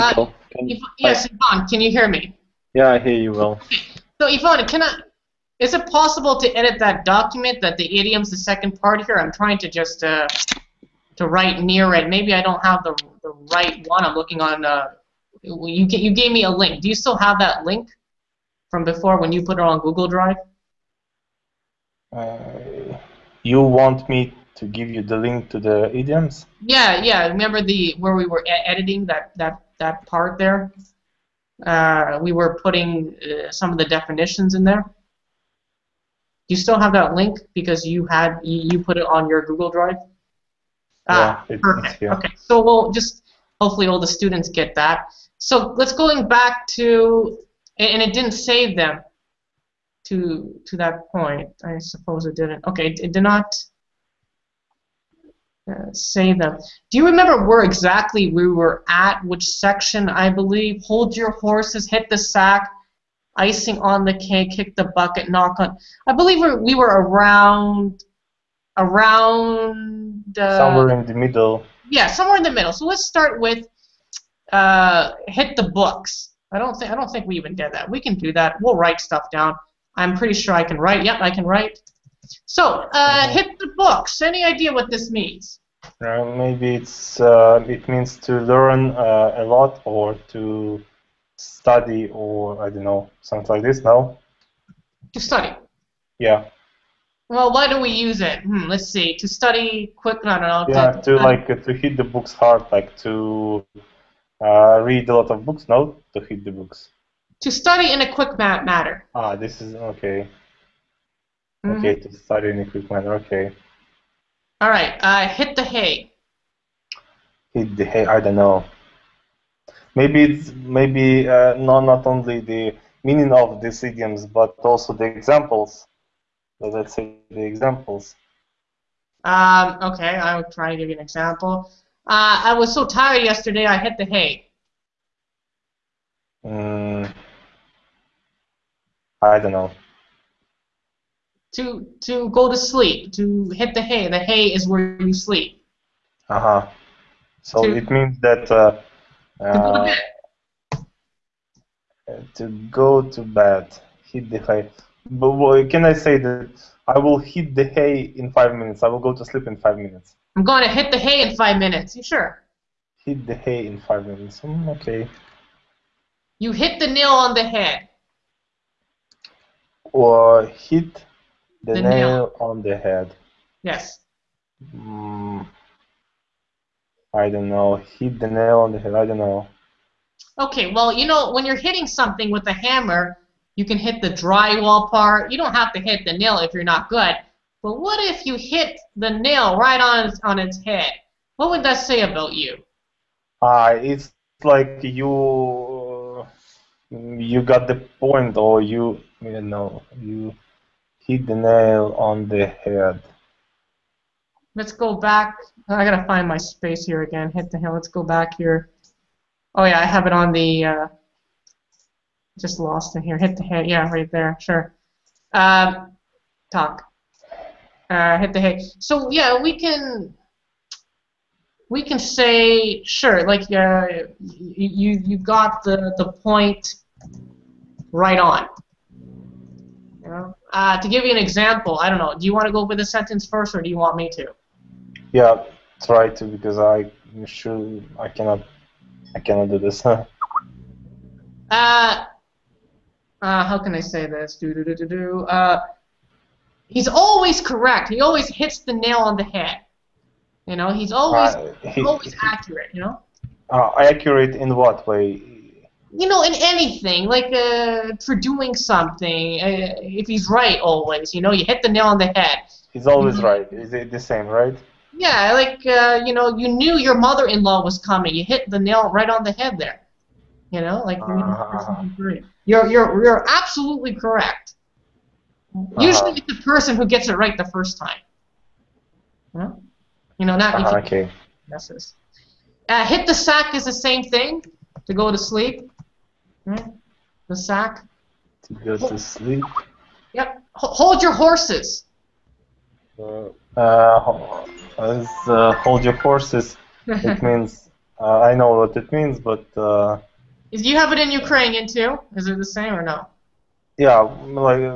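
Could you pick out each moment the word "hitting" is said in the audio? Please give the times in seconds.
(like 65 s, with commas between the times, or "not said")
181 s.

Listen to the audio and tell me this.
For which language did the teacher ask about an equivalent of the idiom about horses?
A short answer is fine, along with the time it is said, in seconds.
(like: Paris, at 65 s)
Ukrainian, at 301 s.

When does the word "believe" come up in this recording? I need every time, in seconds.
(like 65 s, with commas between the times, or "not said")
60 s, 66 s.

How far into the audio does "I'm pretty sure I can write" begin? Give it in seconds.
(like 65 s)
79 s.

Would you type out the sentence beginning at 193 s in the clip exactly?
Uh, it's like you you got the point, or you you know you hit the nail on the head.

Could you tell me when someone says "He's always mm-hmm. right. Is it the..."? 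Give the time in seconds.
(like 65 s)
262 s.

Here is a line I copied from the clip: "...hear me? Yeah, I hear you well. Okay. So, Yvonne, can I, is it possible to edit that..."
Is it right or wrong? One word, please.
right.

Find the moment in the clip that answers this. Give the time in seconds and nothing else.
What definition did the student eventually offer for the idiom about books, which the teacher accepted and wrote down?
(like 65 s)
107 s.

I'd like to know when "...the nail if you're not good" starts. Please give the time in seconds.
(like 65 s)
186 s.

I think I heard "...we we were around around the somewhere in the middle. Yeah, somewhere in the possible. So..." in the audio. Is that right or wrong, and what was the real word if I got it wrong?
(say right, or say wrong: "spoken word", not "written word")
wrong: "middle", not "possible".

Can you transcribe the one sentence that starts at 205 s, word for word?
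I gotta find my space here again.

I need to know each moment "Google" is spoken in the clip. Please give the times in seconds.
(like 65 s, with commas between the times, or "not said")
19 s, 39 s.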